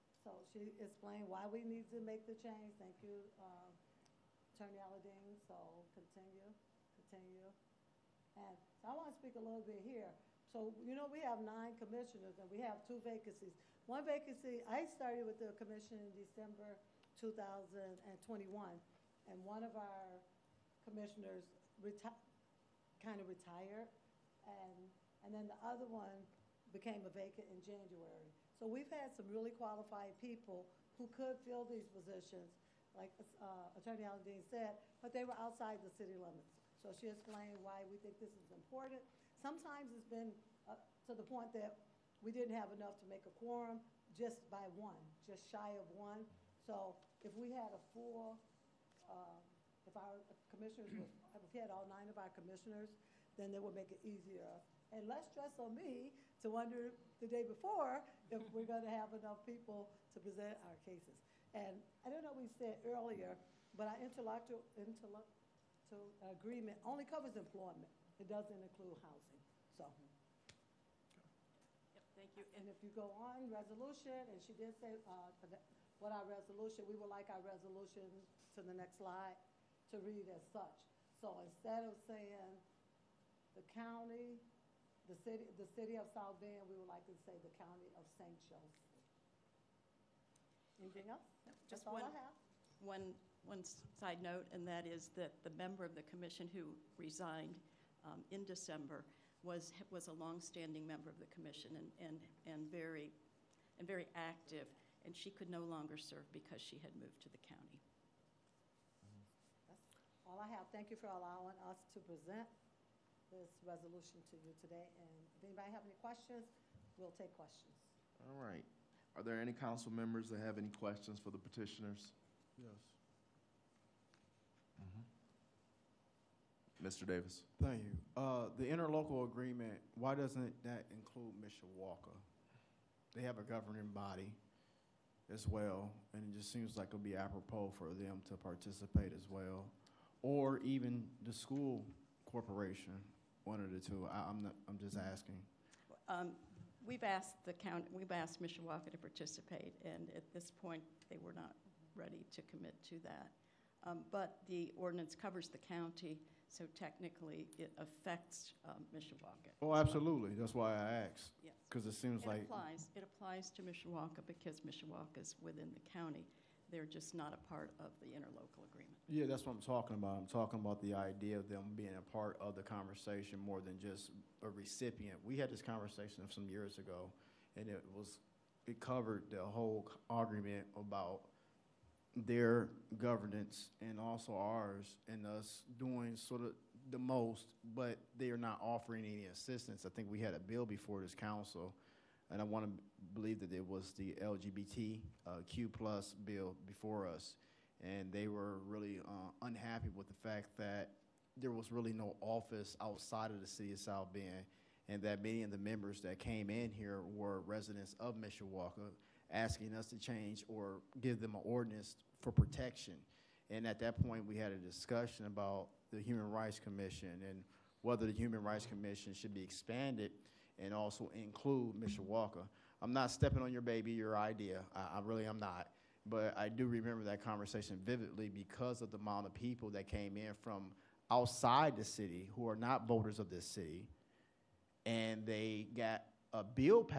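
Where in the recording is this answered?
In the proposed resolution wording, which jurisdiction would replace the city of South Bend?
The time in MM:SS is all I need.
01:27.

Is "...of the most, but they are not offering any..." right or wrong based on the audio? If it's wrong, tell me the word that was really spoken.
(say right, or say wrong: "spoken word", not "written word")
right.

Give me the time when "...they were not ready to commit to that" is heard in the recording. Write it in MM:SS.
02:31.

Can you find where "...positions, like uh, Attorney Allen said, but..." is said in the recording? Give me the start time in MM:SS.
00:31.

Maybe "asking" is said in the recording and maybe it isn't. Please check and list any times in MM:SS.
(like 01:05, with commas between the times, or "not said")
02:24, 03:29.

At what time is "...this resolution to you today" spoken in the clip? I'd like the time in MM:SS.
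01:53.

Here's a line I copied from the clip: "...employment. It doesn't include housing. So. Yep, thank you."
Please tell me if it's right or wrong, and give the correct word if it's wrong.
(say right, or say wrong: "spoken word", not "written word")
right.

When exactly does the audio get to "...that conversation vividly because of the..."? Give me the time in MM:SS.
03:47.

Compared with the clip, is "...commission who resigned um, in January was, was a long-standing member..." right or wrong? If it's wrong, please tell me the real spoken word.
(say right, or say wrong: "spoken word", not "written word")
wrong: "December", not "January".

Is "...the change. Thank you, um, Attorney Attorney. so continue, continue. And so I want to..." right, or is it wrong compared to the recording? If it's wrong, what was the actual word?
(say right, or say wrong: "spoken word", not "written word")
wrong: "Aladean", not "Attorney".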